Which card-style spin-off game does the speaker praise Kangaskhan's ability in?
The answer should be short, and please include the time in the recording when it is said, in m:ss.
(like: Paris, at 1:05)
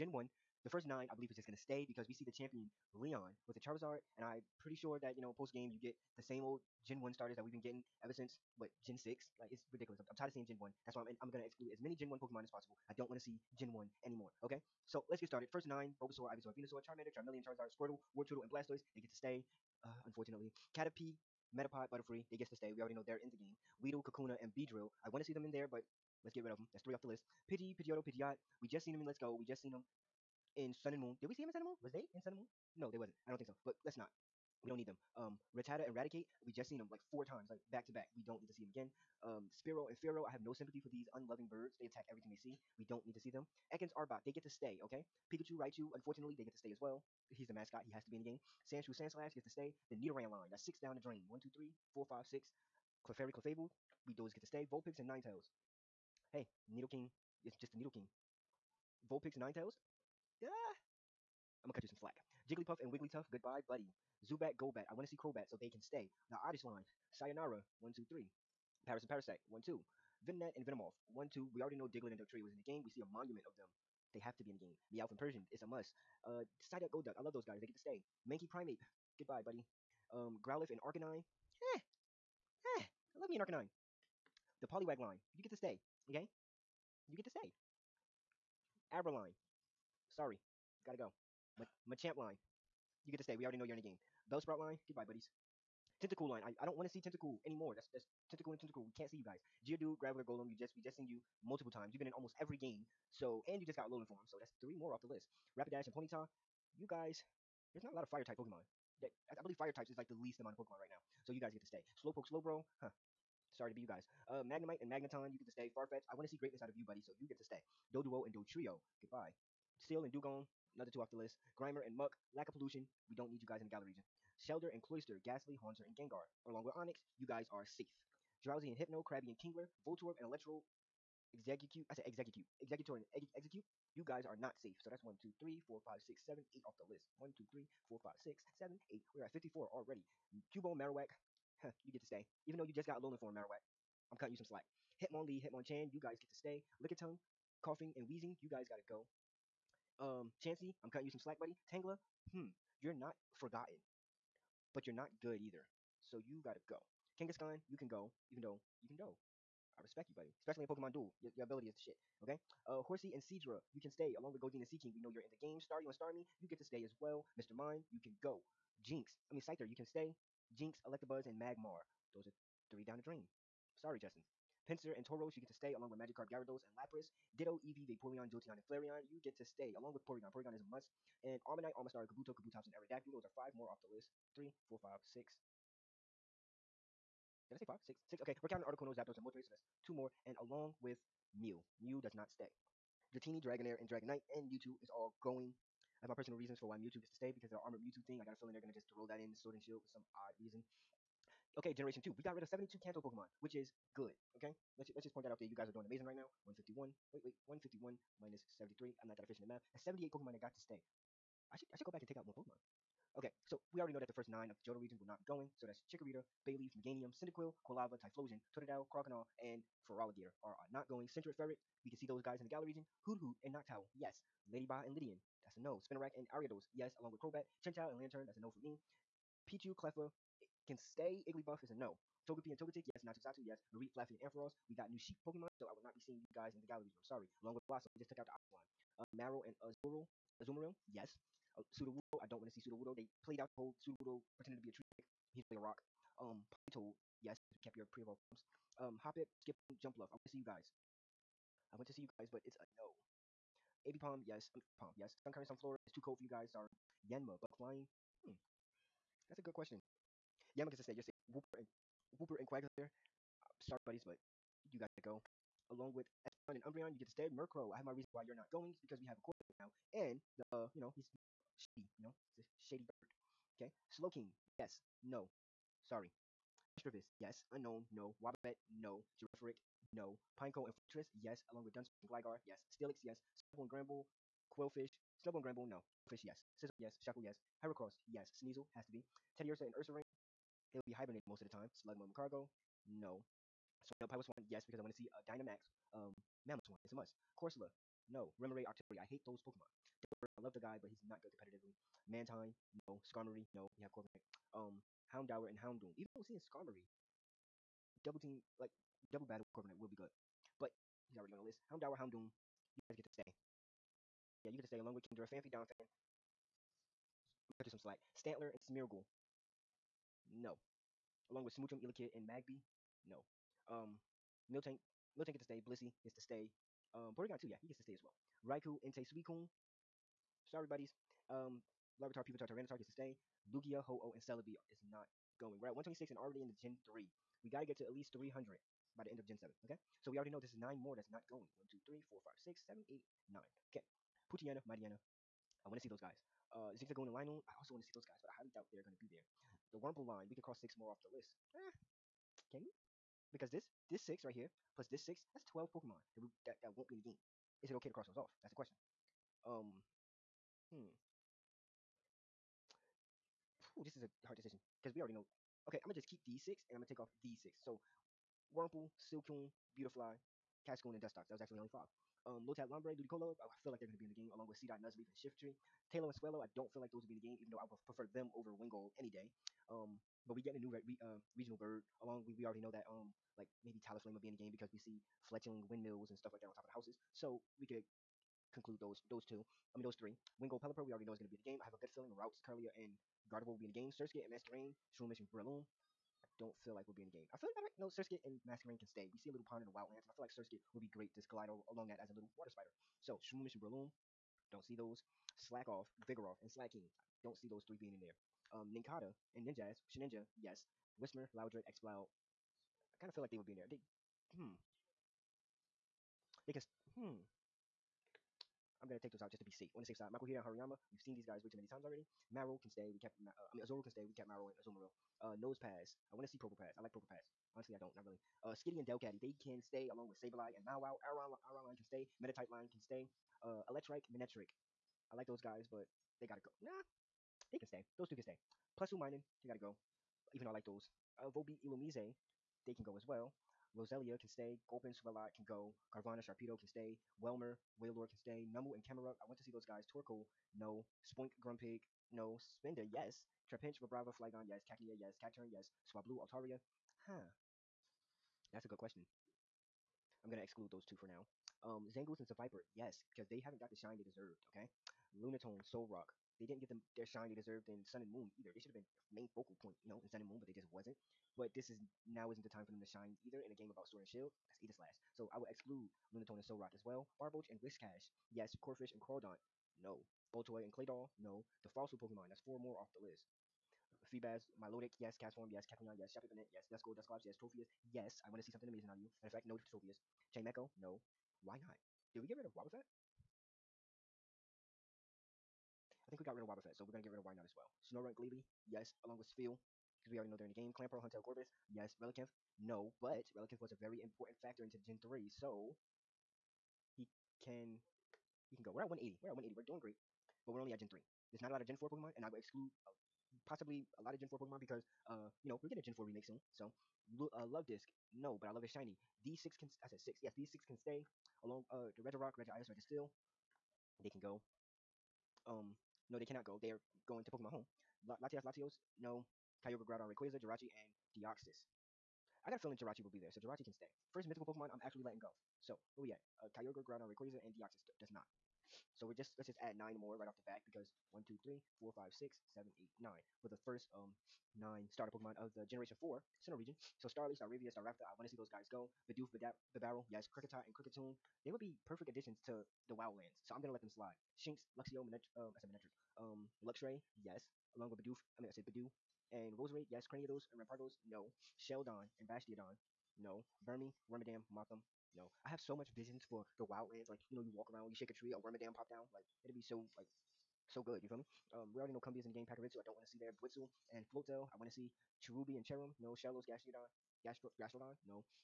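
Pokemon Duel, at 2:40.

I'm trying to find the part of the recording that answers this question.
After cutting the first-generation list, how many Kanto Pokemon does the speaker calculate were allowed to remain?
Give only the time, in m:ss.
3:29.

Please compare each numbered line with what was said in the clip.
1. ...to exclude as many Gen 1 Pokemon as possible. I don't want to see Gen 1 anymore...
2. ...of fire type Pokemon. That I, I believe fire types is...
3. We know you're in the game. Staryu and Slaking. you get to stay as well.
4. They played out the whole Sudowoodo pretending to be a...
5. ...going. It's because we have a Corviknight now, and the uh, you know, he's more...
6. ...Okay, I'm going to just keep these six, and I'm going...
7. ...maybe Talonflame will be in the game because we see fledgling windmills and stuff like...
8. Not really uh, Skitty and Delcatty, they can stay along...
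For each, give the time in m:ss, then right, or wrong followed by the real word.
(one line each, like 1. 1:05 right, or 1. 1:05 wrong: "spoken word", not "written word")
1. 0:11 right
2. 1:48 right
3. 2:44 wrong: "Starmie", not "Slaking"
4. 4:02 right
5. 4:28 right
6. 6:05 right
7. 6:23 right
8. 7:07 right.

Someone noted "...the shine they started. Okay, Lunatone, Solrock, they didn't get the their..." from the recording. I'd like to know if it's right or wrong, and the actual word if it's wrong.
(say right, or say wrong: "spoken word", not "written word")
wrong: "deserved", not "started".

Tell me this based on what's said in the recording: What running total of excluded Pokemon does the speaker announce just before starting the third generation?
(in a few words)
126.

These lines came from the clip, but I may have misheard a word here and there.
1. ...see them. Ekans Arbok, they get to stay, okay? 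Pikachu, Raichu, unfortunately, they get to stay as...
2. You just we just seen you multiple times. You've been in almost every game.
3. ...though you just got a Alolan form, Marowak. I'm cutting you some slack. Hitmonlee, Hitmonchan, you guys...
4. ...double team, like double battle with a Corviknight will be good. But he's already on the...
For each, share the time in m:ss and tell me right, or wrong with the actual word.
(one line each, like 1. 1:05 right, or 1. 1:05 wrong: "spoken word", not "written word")
1. 0:43 right
2. 1:40 right
3. 2:22 right
4. 5:08 right.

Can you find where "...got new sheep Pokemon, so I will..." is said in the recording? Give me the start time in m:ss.
3:54.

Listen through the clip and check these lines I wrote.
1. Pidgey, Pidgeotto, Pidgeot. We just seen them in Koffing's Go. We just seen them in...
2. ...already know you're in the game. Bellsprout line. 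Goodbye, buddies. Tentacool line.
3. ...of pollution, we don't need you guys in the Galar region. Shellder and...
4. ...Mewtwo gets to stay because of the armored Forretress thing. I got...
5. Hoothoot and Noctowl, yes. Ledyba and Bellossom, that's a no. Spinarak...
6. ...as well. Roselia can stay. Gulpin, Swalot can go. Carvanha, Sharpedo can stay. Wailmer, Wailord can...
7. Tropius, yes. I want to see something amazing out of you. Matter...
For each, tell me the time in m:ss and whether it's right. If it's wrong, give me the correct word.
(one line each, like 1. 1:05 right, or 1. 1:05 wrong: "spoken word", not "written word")
1. 0:27 wrong: "Let", not "Koffing"
2. 1:33 right
3. 2:02 right
4. 3:16 wrong: "Mewtwo", not "Forretress"
5. 3:43 wrong: "Ledian", not "Bellossom"
6. 7:22 right
7. 8:07 right.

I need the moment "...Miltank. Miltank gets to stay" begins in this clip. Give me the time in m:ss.
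5:24.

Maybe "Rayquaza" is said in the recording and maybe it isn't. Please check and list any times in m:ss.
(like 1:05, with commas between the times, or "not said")
8:50, 8:57.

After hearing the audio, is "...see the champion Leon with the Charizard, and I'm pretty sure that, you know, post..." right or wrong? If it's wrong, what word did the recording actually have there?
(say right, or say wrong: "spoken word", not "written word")
right.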